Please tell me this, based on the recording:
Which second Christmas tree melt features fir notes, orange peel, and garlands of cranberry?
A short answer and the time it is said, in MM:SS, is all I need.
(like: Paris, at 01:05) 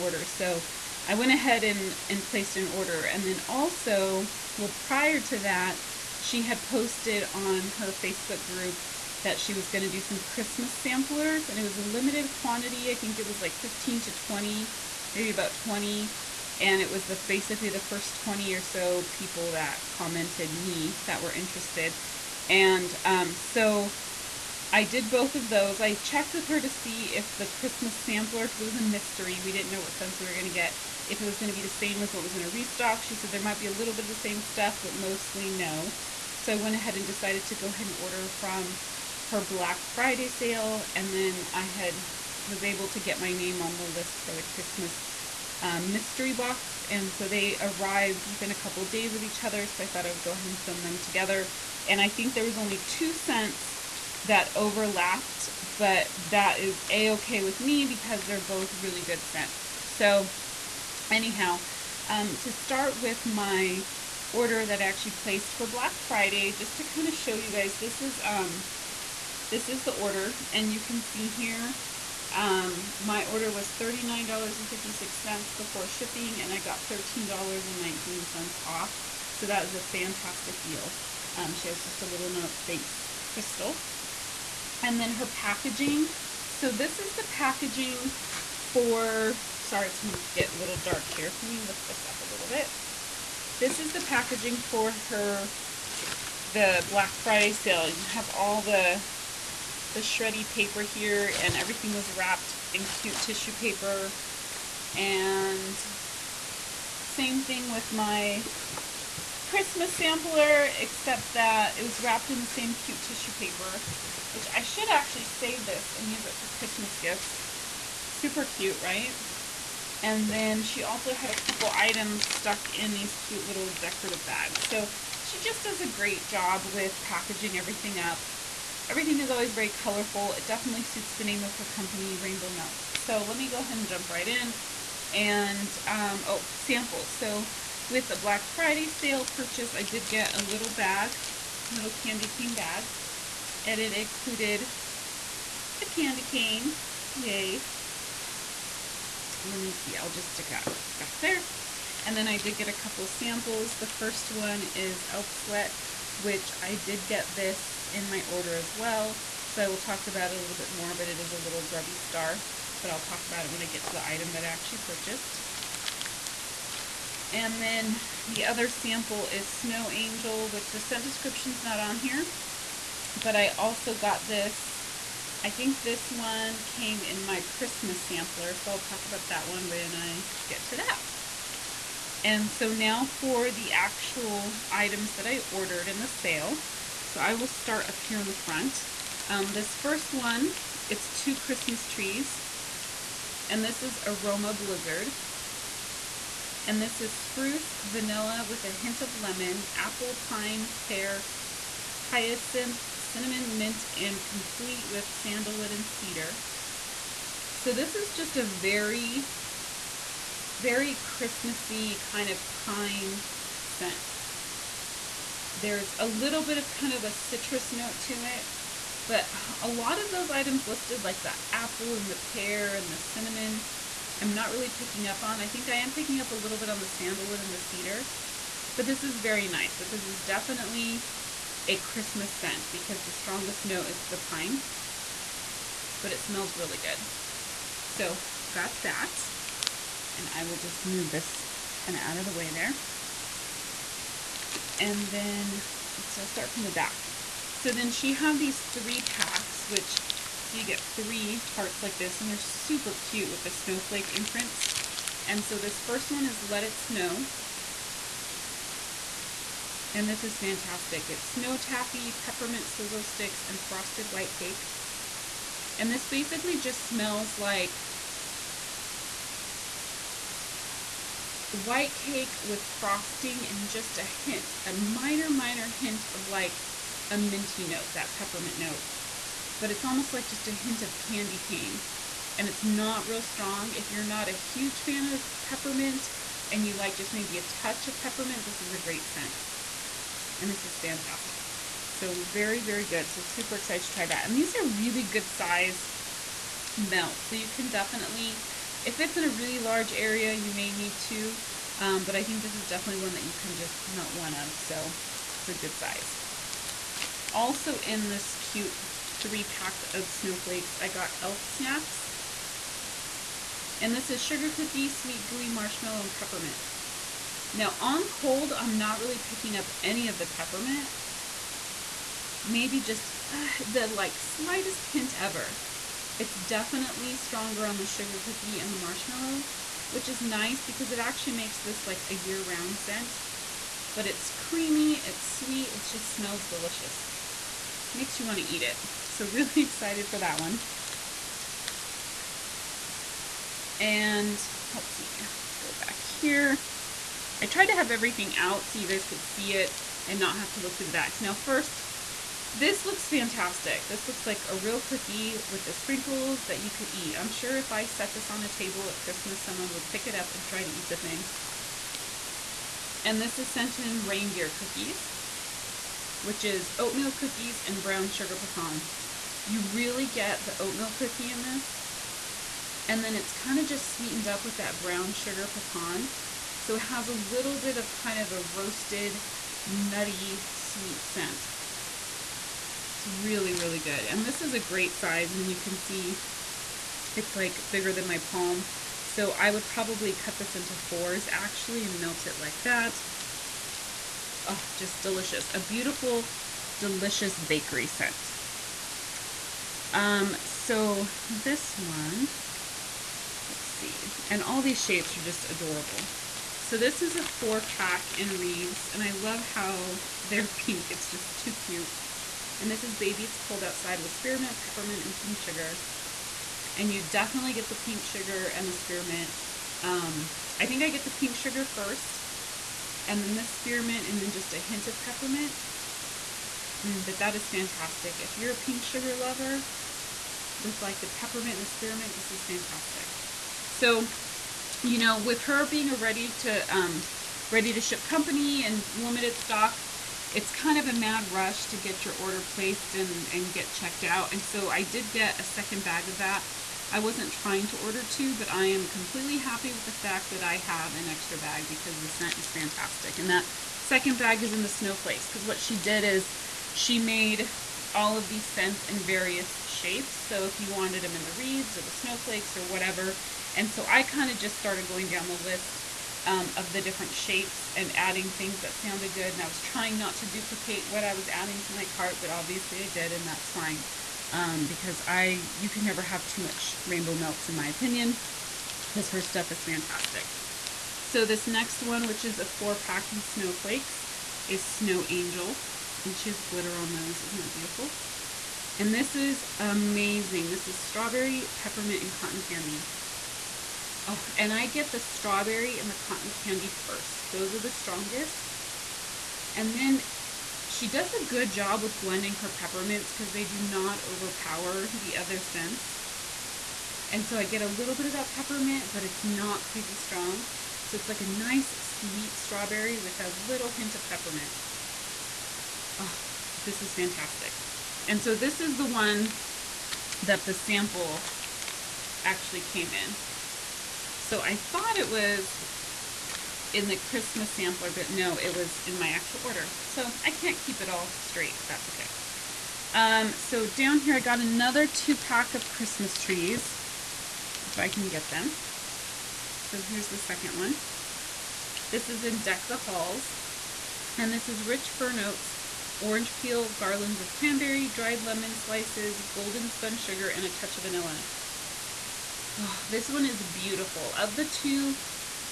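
Deck the Halls, at 09:02.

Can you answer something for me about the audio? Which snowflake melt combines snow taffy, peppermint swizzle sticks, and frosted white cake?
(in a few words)
Let It Snow.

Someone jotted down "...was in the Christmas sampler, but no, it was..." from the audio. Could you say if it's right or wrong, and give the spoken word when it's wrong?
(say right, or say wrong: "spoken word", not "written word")
right.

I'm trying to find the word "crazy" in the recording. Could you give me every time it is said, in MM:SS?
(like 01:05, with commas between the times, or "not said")
08:29.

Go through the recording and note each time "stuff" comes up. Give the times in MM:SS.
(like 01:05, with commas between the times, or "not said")
00:34, 07:59.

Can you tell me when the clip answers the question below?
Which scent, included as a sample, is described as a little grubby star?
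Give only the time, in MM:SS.
02:35.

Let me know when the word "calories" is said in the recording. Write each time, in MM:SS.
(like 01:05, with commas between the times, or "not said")
not said.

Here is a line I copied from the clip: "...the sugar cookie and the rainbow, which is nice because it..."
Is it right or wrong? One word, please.
wrong.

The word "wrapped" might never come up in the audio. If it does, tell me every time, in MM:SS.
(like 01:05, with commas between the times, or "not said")
01:42, 01:52.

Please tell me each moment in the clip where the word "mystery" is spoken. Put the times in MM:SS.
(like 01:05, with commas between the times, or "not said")
00:28, 00:45.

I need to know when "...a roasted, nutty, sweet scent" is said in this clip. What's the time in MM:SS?
06:18.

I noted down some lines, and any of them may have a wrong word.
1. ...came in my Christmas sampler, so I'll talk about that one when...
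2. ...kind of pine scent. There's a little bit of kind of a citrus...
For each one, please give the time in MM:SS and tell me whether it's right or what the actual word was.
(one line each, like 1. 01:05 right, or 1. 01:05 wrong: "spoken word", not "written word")
1. 02:56 right
2. 03:31 right.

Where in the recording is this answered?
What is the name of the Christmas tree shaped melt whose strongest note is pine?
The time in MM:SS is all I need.
03:14.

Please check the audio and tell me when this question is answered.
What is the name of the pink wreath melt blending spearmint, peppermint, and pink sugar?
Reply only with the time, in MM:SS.
06:52.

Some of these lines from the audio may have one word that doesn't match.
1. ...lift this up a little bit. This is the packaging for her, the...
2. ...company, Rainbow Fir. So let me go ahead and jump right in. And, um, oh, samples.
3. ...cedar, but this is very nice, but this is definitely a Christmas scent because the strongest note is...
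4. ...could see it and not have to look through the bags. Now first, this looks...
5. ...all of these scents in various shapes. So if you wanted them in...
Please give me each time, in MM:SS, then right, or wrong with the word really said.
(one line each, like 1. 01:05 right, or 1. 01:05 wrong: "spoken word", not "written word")
1. 01:31 right
2. 02:11 wrong: "Melts", not "Fir"
3. 03:47 right
4. 05:49 right
5. 07:37 right.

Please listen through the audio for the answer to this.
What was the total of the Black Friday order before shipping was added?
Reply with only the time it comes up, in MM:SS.
01:13.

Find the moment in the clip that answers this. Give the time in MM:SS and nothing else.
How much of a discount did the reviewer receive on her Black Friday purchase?
01:16.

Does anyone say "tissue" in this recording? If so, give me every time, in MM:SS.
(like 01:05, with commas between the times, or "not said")
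01:43, 01:52.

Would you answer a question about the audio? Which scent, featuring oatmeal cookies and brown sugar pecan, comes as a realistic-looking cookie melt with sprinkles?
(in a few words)
Reindeer Cookies.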